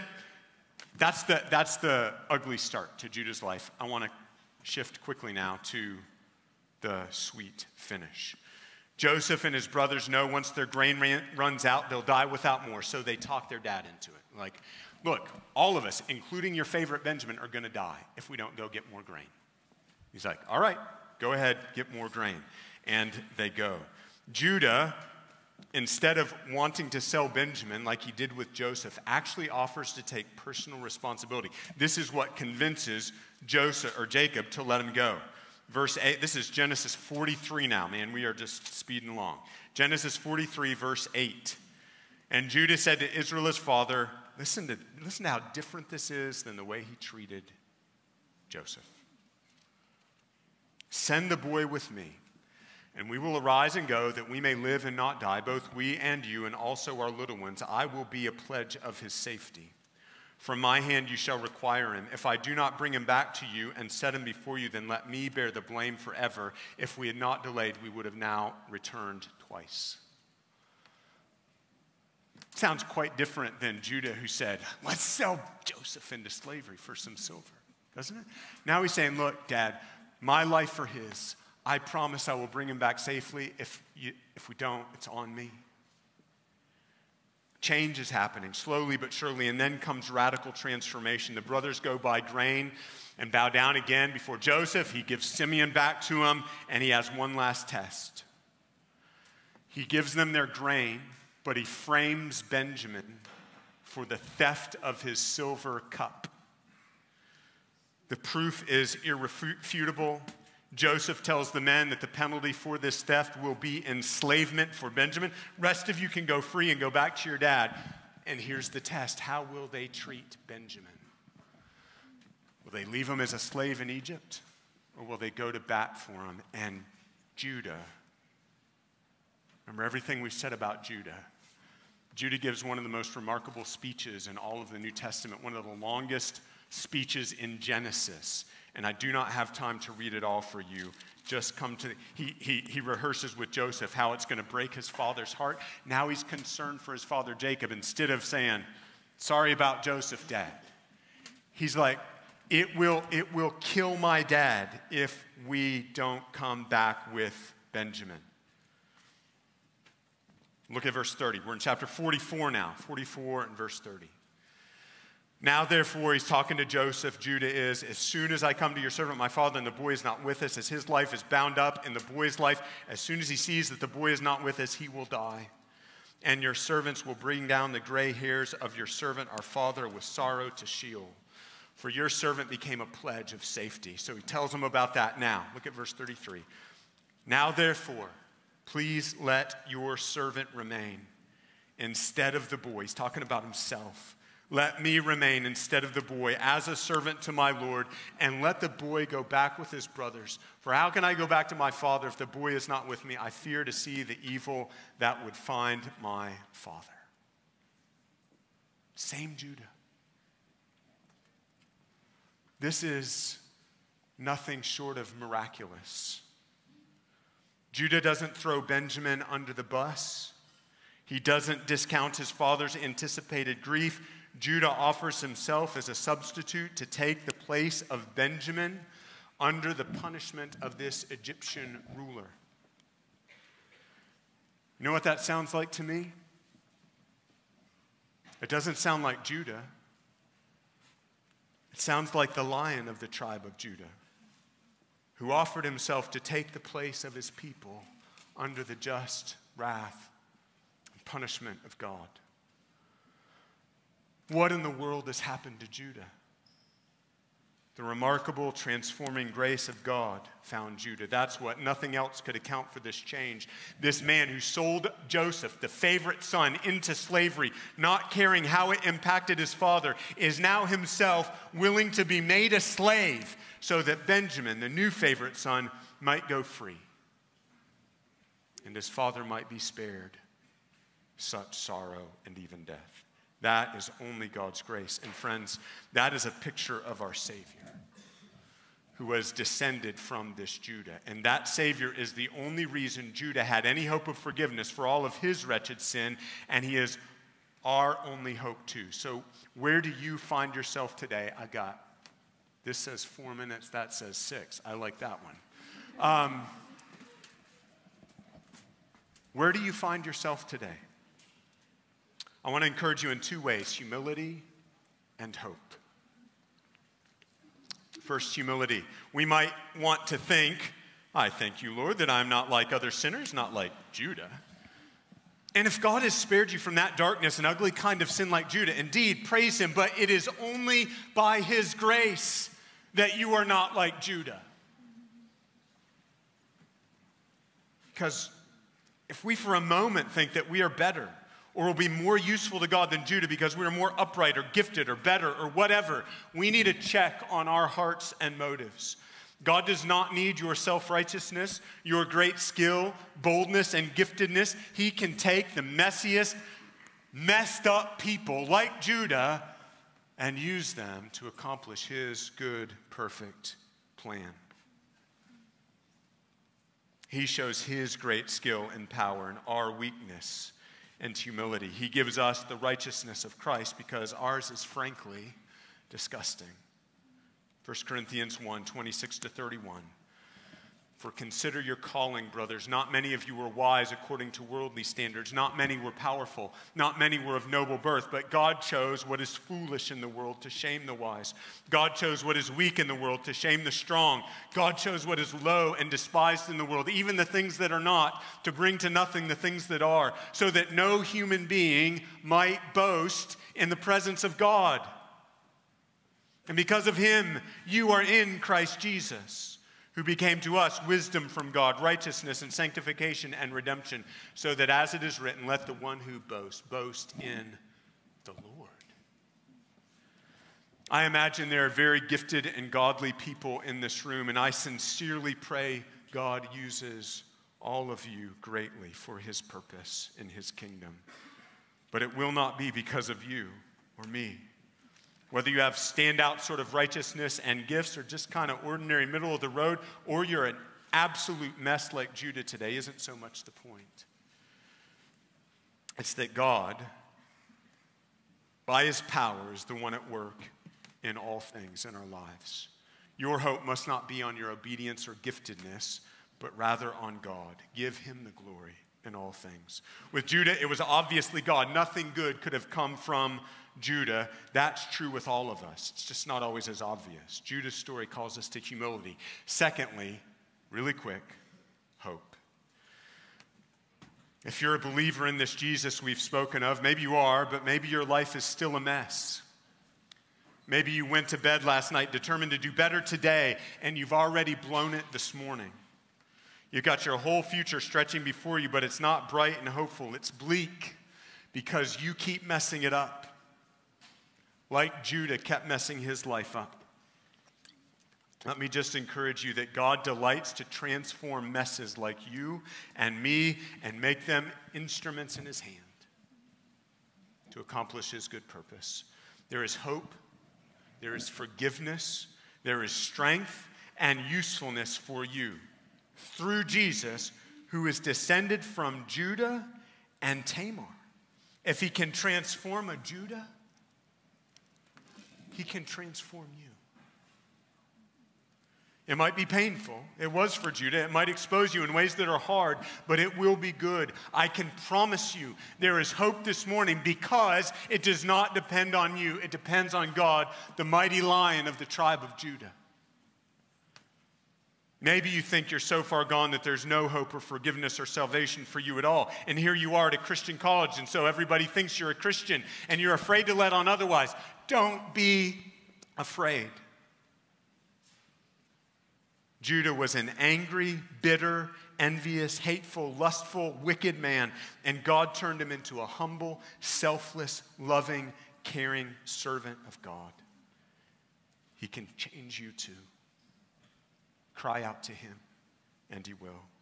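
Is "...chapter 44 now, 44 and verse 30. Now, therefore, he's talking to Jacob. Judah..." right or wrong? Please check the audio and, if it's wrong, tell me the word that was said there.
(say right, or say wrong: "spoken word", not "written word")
wrong: "Joseph", not "Jacob".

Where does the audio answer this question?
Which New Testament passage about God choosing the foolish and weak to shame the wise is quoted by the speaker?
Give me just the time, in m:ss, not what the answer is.
6:17.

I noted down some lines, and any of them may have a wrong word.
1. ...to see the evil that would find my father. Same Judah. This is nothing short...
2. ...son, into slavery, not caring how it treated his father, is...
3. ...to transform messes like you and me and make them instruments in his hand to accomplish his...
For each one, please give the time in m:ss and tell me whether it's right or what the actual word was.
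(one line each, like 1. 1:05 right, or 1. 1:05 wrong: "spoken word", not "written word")
1. 3:23 right
2. 4:26 wrong: "impacted", not "treated"
3. 8:20 right.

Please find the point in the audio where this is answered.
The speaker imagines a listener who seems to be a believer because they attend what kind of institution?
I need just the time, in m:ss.
9:10.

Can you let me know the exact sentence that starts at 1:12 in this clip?
Sounds quite different than Judah, who said, Let's sell Joseph into slavery for some silver, doesn't it?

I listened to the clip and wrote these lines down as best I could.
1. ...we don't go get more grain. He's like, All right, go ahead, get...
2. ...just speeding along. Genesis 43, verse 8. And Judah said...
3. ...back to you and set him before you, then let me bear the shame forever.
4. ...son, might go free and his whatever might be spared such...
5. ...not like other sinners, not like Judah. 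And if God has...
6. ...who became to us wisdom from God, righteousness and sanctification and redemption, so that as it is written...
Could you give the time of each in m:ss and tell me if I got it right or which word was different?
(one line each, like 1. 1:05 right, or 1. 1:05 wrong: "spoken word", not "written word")
1. 0:18 right
2. 0:38 right
3. 1:03 wrong: "blame", not "shame"
4. 4:35 wrong: "father", not "whatever"
5. 5:22 right
6. 6:49 right.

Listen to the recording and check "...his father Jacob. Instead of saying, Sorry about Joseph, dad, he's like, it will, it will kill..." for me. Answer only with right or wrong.
right.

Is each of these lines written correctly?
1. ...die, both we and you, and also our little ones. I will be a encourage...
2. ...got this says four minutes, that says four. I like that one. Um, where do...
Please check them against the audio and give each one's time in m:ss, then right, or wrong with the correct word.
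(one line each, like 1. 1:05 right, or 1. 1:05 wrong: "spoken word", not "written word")
1. 0:55 wrong: "pledge", not "encourage"
2. 5:01 wrong: "six", not "four".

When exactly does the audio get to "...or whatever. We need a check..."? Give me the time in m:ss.
5:45.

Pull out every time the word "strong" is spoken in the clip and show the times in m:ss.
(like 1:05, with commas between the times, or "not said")
6:33.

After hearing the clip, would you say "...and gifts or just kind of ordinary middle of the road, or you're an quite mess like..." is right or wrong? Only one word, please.
wrong.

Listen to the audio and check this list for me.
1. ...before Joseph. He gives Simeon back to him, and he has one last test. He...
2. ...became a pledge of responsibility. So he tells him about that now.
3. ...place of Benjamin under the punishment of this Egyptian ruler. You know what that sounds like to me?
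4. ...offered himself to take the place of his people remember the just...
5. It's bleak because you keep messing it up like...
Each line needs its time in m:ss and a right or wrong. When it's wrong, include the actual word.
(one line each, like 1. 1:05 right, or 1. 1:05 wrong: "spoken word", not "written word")
1. 1:34 right
2. 3:02 wrong: "safety", not "responsibility"
3. 3:47 right
4. 4:05 wrong: "under", not "remember"
5. 8:10 right.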